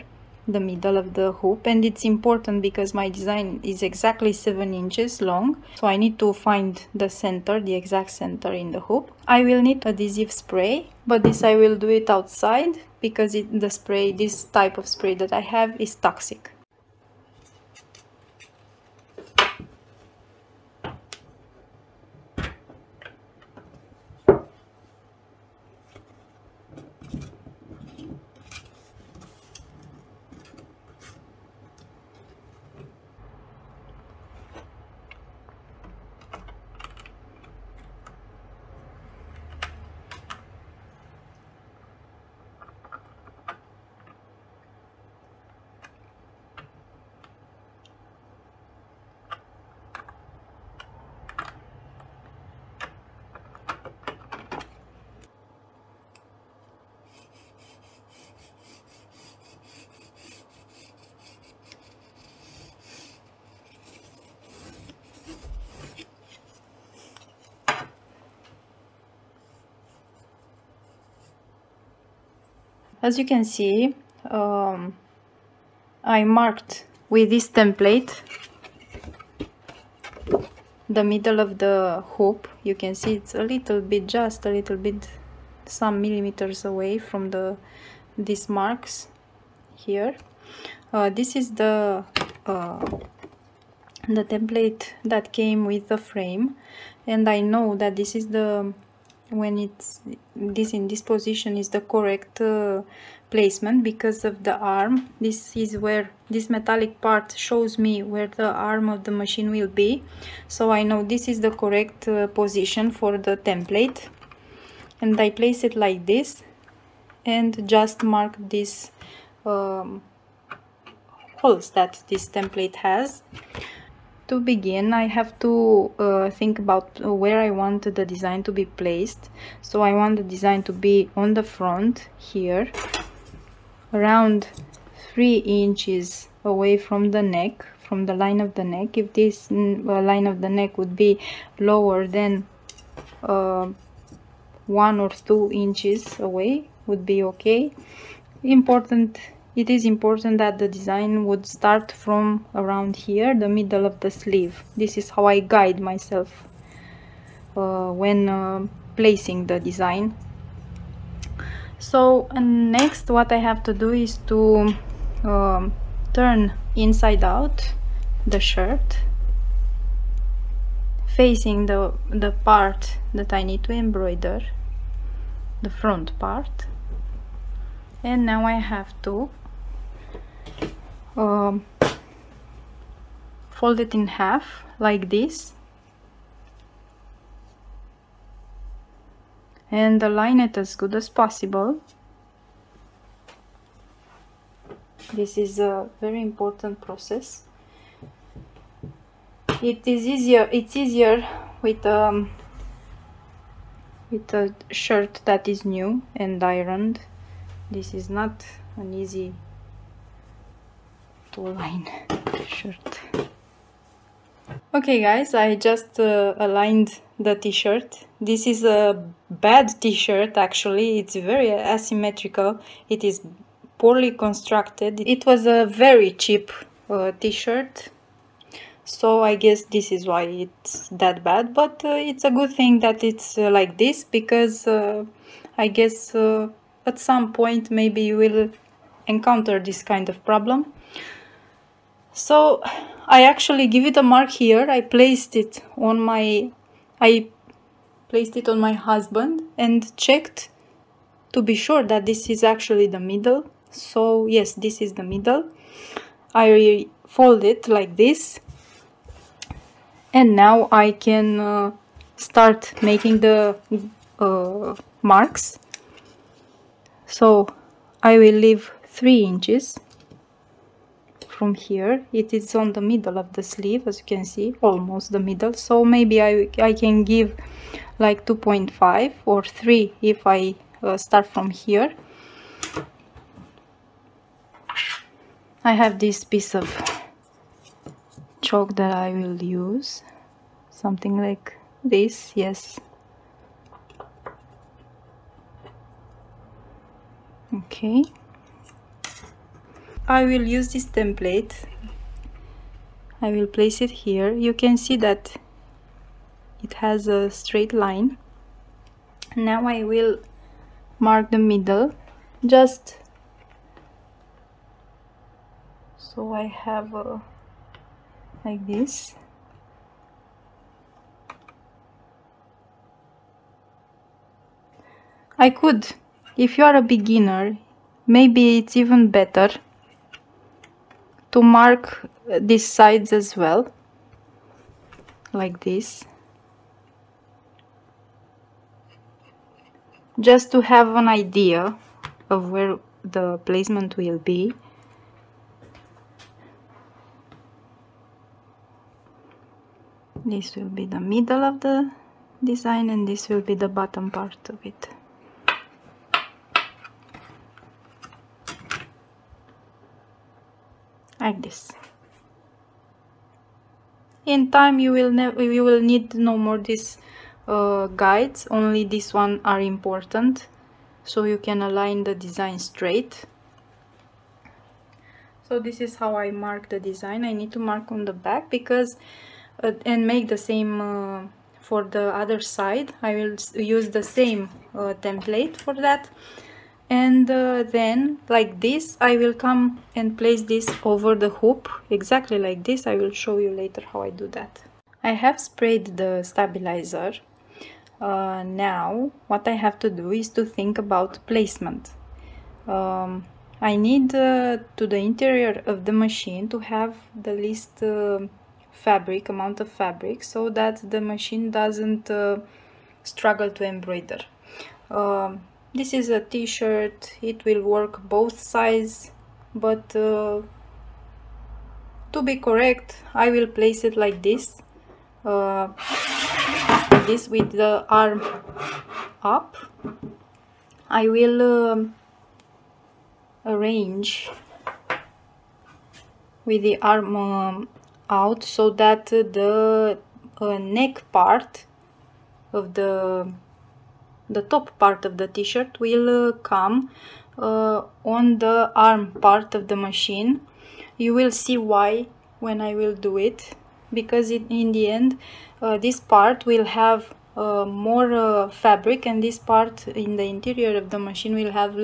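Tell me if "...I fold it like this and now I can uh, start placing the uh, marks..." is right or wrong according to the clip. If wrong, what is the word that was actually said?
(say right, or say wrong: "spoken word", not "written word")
wrong: "making", not "placing".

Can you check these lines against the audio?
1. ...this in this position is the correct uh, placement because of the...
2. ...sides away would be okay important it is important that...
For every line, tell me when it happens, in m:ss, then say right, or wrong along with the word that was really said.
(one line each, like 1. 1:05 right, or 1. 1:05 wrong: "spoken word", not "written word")
1. 1:40 right
2. 2:25 wrong: "inches", not "sides".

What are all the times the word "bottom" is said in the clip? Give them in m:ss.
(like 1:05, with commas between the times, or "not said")
5:53.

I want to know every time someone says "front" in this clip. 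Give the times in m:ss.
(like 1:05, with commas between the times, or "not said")
2:11, 2:55.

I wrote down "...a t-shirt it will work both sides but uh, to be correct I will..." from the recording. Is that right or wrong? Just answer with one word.
right.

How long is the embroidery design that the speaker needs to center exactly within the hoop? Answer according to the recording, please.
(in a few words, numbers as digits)
7 inches.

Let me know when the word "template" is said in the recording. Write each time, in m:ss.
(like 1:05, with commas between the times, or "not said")
1:17, 1:34, 1:53, 2:02, 5:00, 6:25.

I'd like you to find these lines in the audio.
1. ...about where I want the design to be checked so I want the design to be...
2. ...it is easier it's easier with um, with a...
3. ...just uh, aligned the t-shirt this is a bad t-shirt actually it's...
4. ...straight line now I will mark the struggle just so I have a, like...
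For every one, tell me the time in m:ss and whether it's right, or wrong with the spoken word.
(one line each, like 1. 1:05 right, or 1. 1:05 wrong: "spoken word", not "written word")
1. 2:06 wrong: "placed", not "checked"
2. 3:19 right
3. 3:35 right
4. 5:07 wrong: "middle", not "struggle".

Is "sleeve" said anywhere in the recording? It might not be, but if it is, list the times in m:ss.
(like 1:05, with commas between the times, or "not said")
2:34, 4:33.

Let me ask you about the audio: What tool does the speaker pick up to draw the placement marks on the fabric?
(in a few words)
Chalk.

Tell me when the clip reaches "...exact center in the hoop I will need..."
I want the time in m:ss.
0:07.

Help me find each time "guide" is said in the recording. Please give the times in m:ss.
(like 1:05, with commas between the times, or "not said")
2:35, 6:08.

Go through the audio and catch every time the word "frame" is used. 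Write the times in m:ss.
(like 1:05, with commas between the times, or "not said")
1:35.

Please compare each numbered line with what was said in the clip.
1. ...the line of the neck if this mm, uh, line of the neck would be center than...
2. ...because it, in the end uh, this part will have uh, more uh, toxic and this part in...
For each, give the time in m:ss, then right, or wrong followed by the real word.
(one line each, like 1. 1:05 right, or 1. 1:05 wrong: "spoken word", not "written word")
1. 2:18 wrong: "lower", not "center"
2. 7:33 wrong: "fabric", not "toxic".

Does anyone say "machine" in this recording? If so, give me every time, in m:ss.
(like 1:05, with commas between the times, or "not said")
1:49, 6:45, 6:50, 7:29, 7:40.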